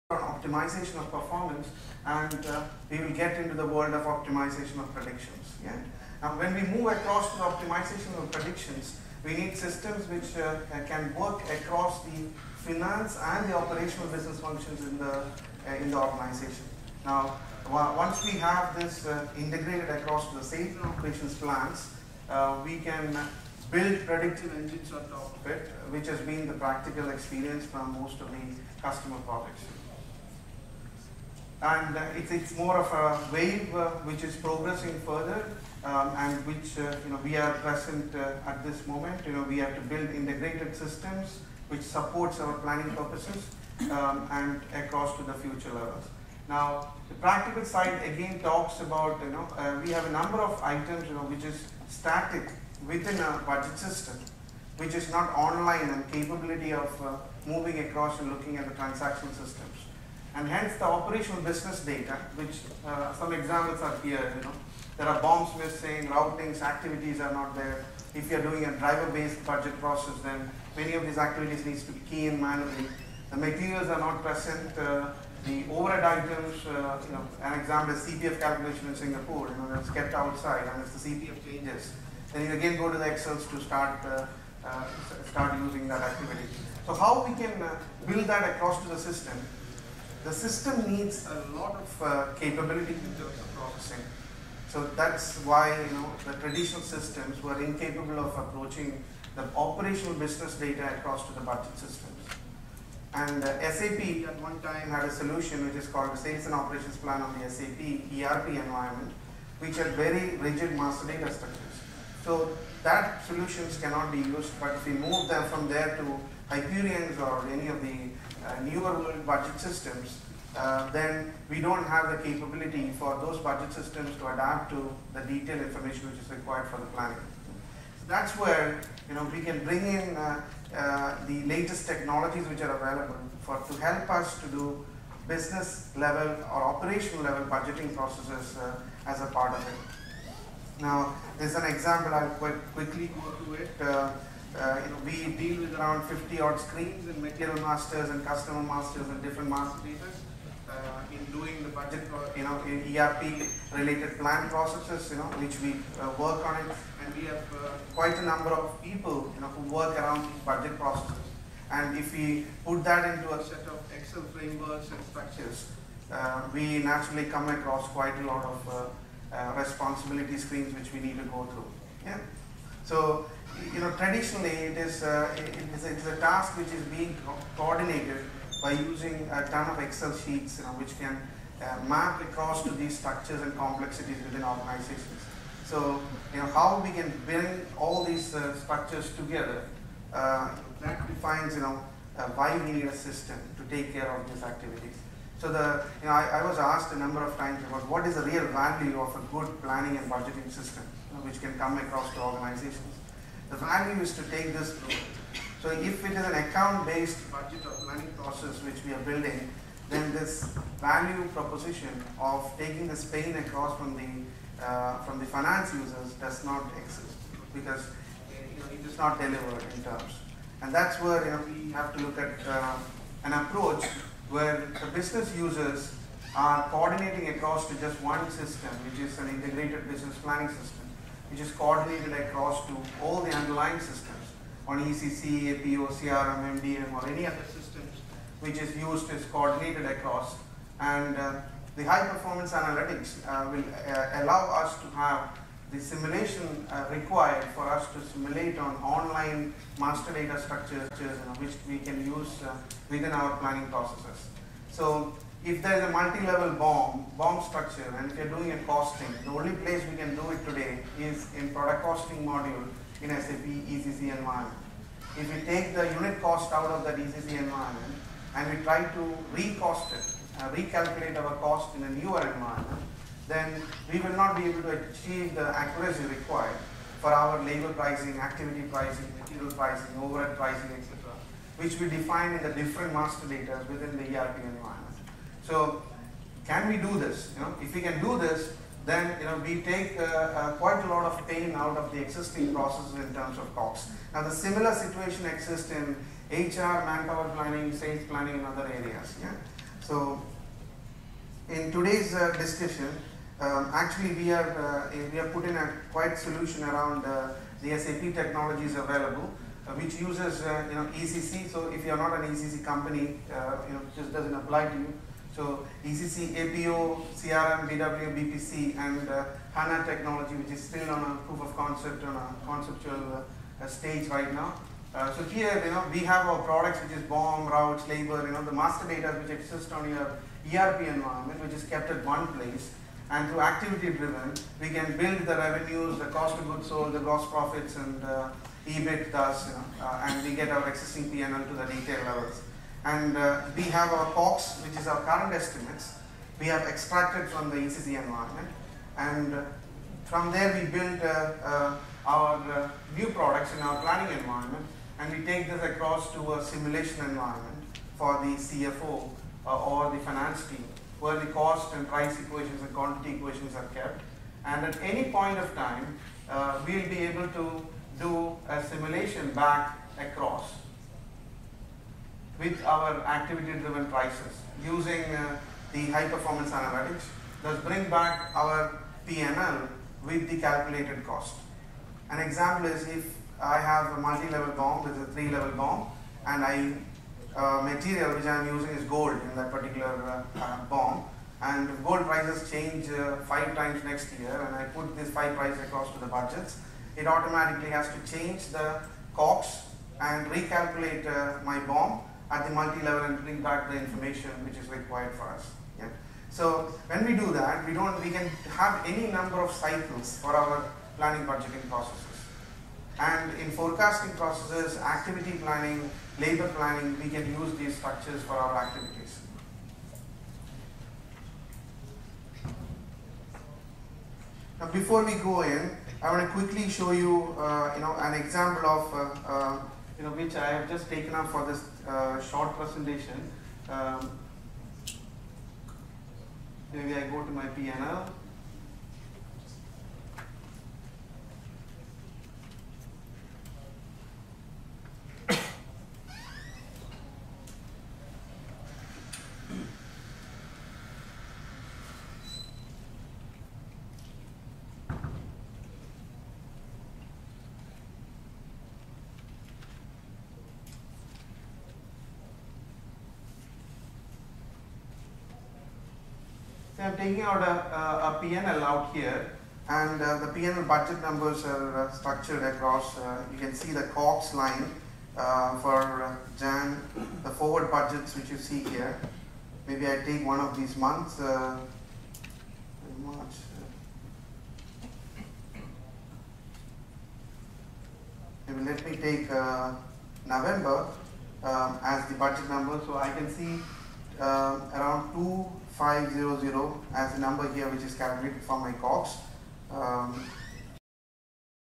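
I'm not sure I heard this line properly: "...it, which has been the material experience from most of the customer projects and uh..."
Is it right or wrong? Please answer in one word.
wrong.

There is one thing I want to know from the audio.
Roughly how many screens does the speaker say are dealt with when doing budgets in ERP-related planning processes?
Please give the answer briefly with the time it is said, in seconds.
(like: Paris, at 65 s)
50, at 146 s.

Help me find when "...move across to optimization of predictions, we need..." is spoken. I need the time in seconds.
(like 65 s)
6 s.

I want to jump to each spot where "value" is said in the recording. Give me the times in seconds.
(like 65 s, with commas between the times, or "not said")
198 s, 203 s, 210 s.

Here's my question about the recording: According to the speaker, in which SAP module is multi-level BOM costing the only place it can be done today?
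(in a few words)
product costing module.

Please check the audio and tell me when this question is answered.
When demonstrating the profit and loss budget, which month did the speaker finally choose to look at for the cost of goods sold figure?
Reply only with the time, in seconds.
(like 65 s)
490 s.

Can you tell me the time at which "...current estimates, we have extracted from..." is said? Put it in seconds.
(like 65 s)
345 s.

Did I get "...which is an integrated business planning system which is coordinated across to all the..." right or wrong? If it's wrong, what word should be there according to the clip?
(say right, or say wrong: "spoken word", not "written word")
right.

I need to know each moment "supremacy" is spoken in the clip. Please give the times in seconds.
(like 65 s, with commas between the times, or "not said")
not said.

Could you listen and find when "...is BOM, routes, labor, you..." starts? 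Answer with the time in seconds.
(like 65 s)
326 s.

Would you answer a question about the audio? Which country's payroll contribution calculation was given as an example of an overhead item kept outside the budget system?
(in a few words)
Singapore.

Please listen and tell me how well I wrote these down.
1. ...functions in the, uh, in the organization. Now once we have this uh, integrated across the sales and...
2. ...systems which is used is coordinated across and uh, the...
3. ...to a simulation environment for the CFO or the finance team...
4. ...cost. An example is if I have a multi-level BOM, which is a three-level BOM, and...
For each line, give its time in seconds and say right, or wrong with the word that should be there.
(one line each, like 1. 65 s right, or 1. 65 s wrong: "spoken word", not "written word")
1. 14 s right
2. 237 s right
3. 356 s right
4. 381 s right.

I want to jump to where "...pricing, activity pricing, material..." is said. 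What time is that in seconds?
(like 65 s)
277 s.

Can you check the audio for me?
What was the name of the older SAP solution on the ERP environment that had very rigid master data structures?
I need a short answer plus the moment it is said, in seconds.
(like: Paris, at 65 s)
Sales and Operations Plan, at 106 s.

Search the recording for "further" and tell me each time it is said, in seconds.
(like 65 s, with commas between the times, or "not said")
35 s.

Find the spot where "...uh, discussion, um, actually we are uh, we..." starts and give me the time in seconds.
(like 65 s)
302 s.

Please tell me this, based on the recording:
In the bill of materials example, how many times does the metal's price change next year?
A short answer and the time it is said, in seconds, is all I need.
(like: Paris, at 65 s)
5, at 393 s.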